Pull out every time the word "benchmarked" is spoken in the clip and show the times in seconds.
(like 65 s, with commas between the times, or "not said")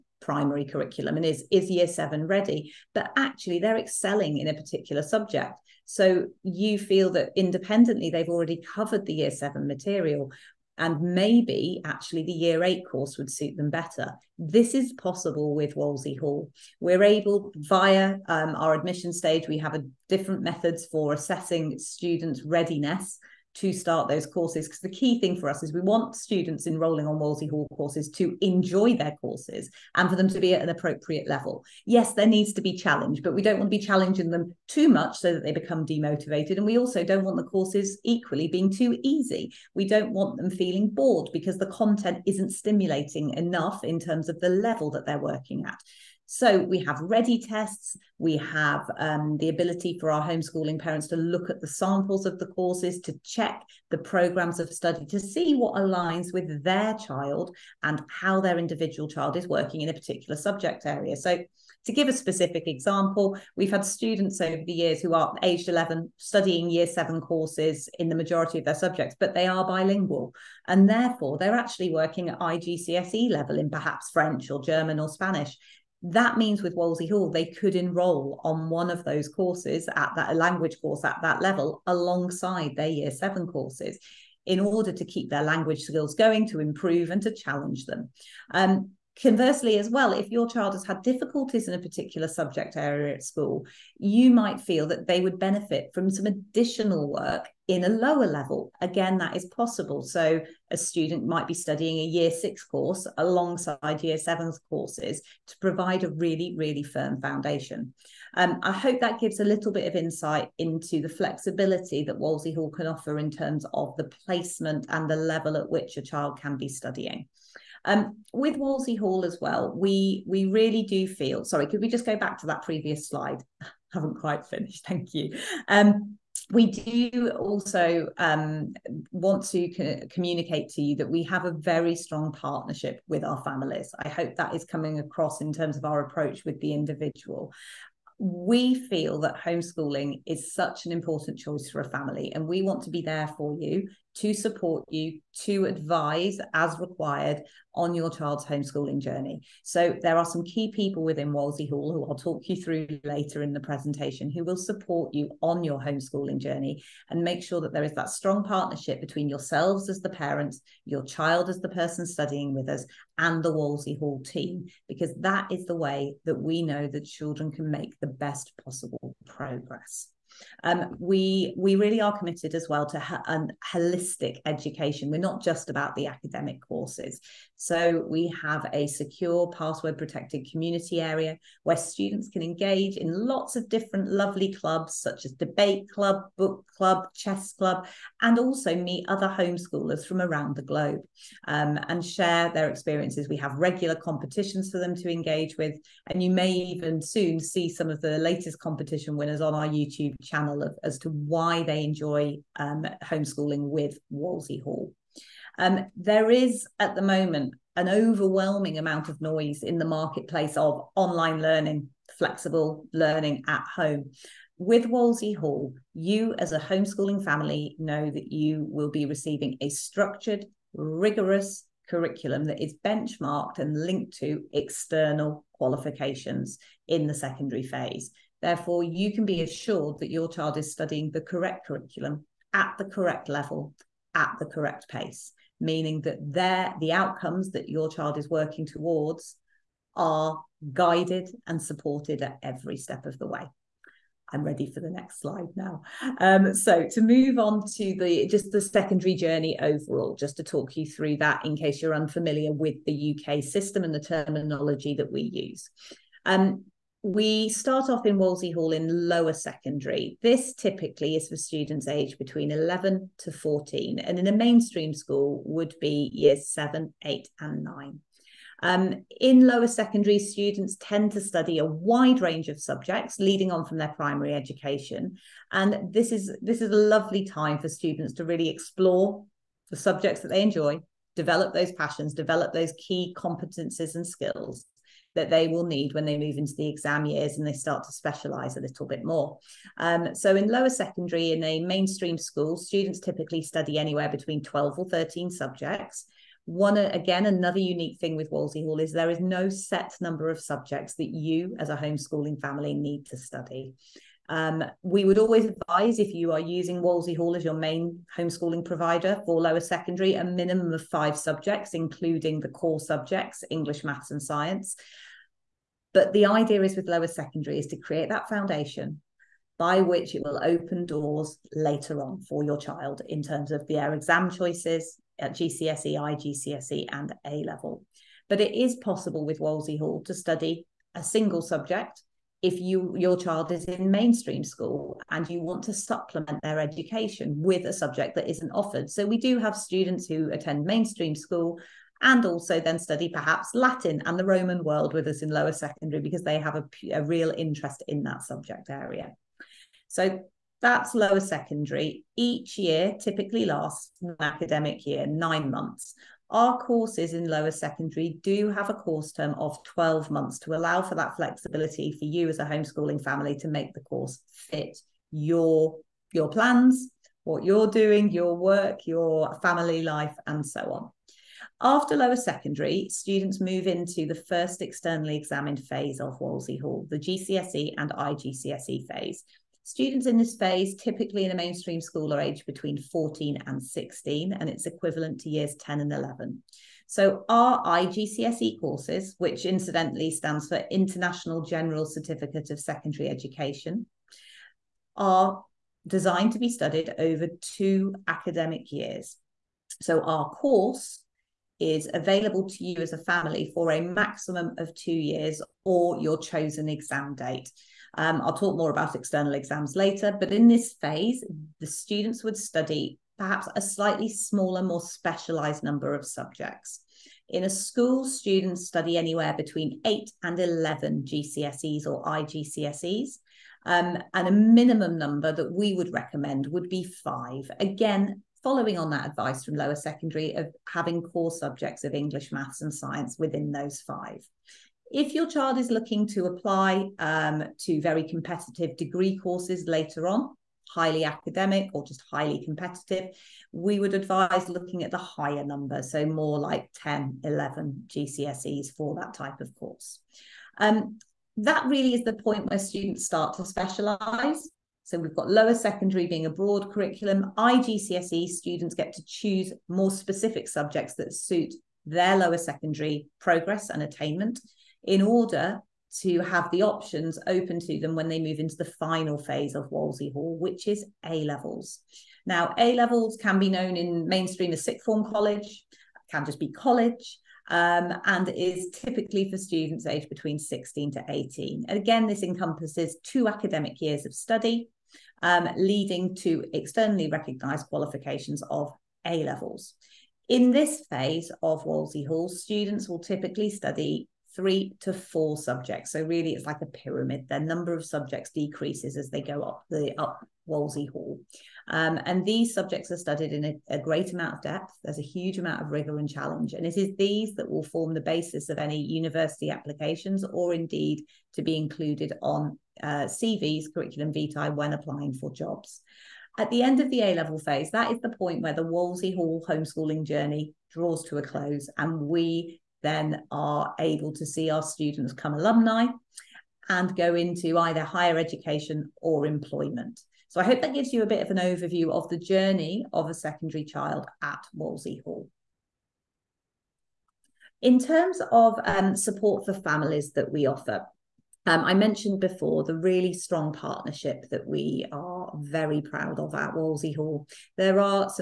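222 s.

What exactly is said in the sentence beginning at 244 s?
I'm ready for the next slide now.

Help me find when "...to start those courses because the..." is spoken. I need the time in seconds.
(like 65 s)
23 s.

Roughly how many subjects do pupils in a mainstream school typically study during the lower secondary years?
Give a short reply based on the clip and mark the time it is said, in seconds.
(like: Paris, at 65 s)
12 or 13, at 294 s.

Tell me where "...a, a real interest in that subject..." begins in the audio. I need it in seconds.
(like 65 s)
346 s.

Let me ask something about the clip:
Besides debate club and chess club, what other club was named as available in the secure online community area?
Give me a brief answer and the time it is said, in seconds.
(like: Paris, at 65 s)
Book club, at 186 s.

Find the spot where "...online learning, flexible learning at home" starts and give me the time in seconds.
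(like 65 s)
210 s.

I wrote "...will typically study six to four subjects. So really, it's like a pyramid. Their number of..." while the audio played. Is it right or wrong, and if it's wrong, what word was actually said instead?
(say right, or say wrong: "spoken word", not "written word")
wrong: "three", not "six".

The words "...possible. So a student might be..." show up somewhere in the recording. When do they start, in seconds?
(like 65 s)
99 s.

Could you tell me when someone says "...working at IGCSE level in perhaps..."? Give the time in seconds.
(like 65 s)
71 s.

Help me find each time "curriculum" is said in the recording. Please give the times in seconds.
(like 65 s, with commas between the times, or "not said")
0 s, 221 s, 231 s, 456 s, 513 s.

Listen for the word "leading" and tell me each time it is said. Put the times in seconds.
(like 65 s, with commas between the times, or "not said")
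273 s, 485 s.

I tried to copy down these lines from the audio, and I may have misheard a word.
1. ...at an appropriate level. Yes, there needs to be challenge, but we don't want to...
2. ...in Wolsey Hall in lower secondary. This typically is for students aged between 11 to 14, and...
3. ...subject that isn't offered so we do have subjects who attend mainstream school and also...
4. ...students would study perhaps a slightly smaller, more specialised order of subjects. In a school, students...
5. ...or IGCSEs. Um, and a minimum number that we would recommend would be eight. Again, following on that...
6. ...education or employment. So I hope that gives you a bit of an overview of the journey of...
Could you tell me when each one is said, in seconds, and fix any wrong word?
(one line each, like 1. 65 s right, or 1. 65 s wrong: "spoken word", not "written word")
1. 30 s right
2. 258 s right
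3. 337 s wrong: "students", not "subjects"
4. 411 s wrong: "number", not "order"
5. 421 s wrong: "five", not "eight"
6. 528 s right.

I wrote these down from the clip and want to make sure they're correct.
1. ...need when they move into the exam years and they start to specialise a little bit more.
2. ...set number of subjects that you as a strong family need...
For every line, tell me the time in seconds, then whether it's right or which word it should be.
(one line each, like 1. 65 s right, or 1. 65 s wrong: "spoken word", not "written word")
1. 285 s right
2. 299 s wrong: "homeschooling", not "strong".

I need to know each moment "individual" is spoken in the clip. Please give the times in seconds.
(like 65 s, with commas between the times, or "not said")
58 s, 136 s.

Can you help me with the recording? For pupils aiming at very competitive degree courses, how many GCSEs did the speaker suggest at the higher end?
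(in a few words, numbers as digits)
10 or 11.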